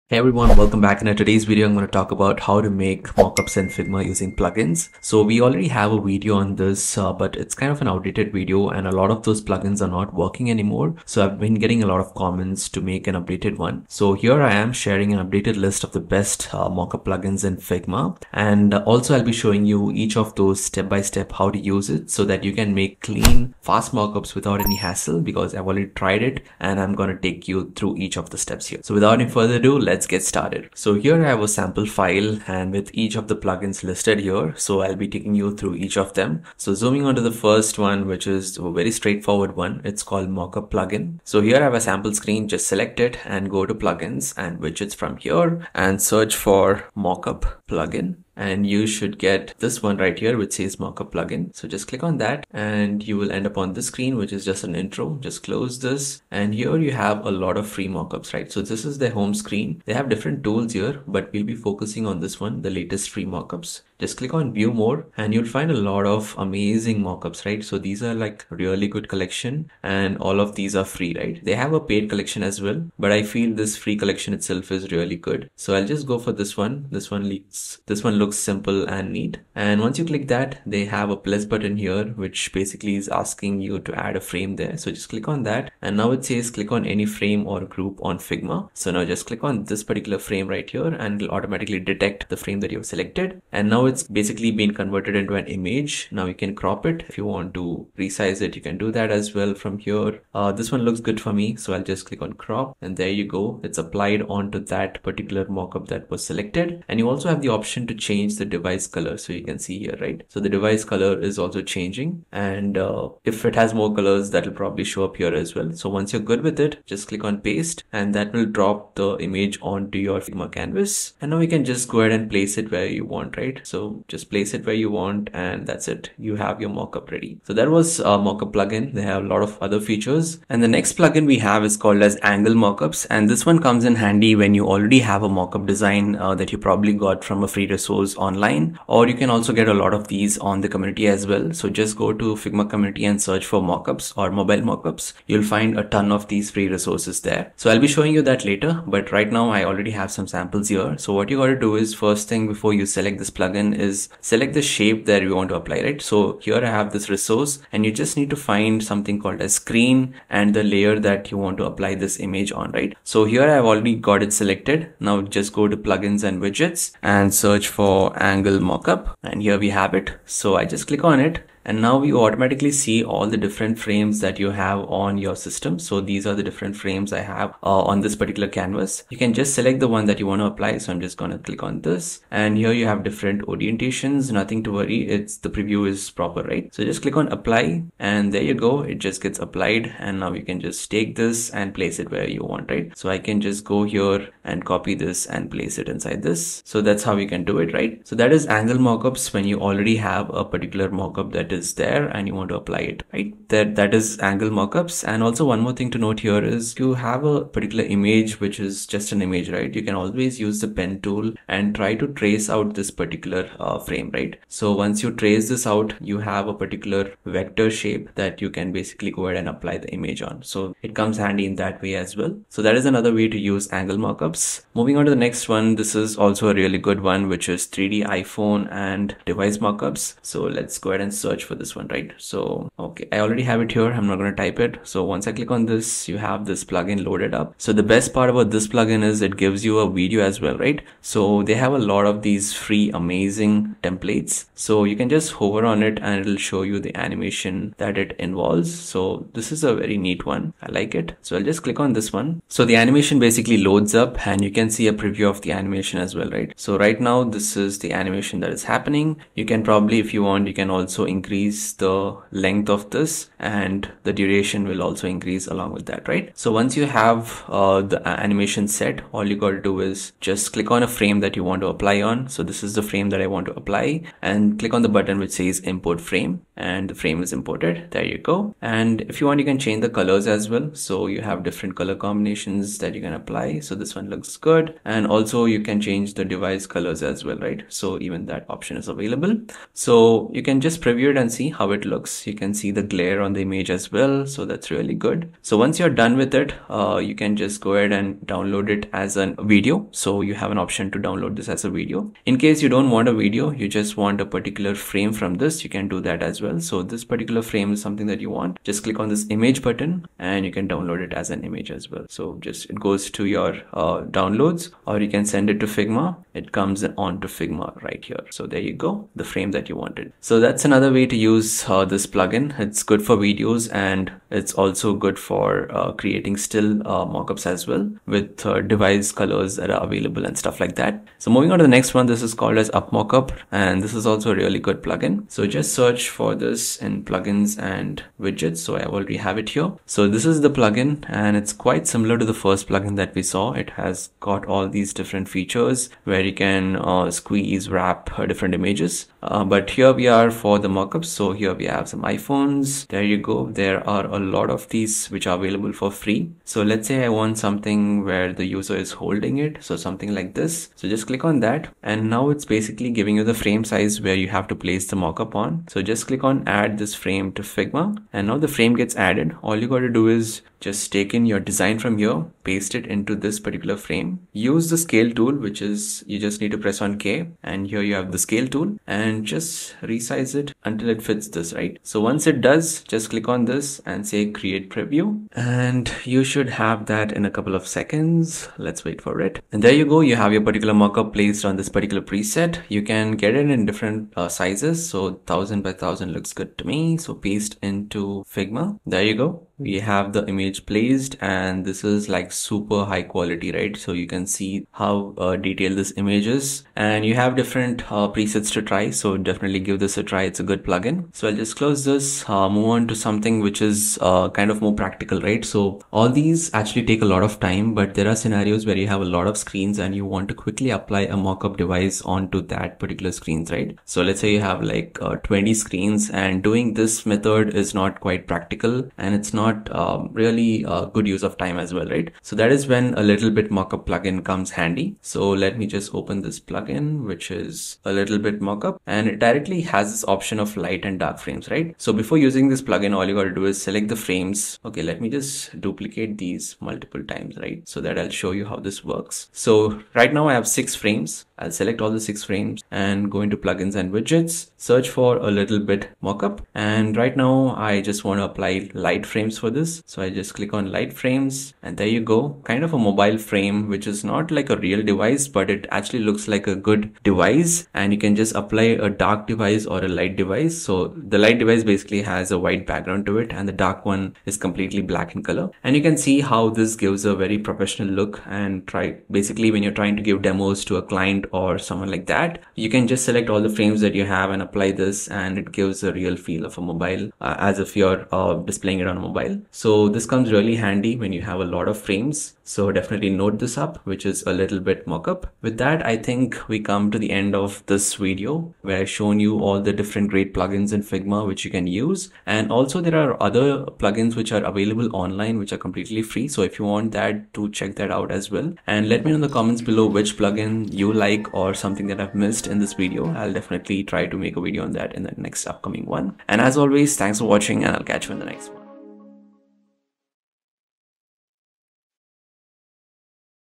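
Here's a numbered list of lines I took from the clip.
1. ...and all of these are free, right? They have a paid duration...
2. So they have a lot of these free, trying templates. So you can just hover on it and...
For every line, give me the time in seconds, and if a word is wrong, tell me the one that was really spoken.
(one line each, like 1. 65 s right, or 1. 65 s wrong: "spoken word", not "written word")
1. 69 s wrong: "collection", not "duration"
2. 241 s wrong: "amazing", not "trying".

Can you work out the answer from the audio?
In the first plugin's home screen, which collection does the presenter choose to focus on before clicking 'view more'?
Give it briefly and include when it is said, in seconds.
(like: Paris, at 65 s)
Latest free mockups, at 62 s.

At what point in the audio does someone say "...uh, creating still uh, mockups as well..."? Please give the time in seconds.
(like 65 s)
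325 s.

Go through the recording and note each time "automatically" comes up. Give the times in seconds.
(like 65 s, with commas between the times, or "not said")
91 s, 172 s.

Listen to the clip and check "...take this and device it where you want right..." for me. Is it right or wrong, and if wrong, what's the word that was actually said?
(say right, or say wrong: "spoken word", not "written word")
wrong: "place", not "device".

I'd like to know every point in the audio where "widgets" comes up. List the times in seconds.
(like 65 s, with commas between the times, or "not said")
44 s, 166 s, 338 s, 453 s.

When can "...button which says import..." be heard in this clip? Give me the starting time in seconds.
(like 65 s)
274 s.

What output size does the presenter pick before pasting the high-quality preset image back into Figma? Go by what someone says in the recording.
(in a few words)
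1000 by 1000.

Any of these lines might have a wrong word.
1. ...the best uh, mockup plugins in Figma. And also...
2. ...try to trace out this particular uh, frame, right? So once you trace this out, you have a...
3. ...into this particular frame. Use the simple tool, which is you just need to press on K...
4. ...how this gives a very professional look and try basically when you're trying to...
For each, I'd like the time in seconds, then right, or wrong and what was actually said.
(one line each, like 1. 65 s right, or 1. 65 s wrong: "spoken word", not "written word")
1. 15 s right
2. 211 s right
3. 372 s wrong: "scale", not "simple"
4. 476 s right.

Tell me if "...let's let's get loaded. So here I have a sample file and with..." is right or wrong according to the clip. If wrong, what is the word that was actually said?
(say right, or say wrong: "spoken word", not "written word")
wrong: "started", not "loaded".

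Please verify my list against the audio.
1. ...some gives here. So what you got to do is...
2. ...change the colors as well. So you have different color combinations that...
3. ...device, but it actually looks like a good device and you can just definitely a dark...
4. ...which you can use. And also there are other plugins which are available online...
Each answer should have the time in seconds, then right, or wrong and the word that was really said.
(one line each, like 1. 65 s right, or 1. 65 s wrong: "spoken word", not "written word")
1. 150 s wrong: "samples", not "gives"
2. 279 s right
3. 464 s wrong: "apply", not "definitely"
4. 501 s right.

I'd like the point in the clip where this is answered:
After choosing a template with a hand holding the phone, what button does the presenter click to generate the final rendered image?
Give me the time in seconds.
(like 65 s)
384 s.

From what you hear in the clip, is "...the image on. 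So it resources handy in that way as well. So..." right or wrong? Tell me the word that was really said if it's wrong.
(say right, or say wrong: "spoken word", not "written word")
wrong: "comes", not "resources".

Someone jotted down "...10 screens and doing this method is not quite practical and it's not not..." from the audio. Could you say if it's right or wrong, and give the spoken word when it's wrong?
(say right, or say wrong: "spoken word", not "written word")
wrong: "20", not "10".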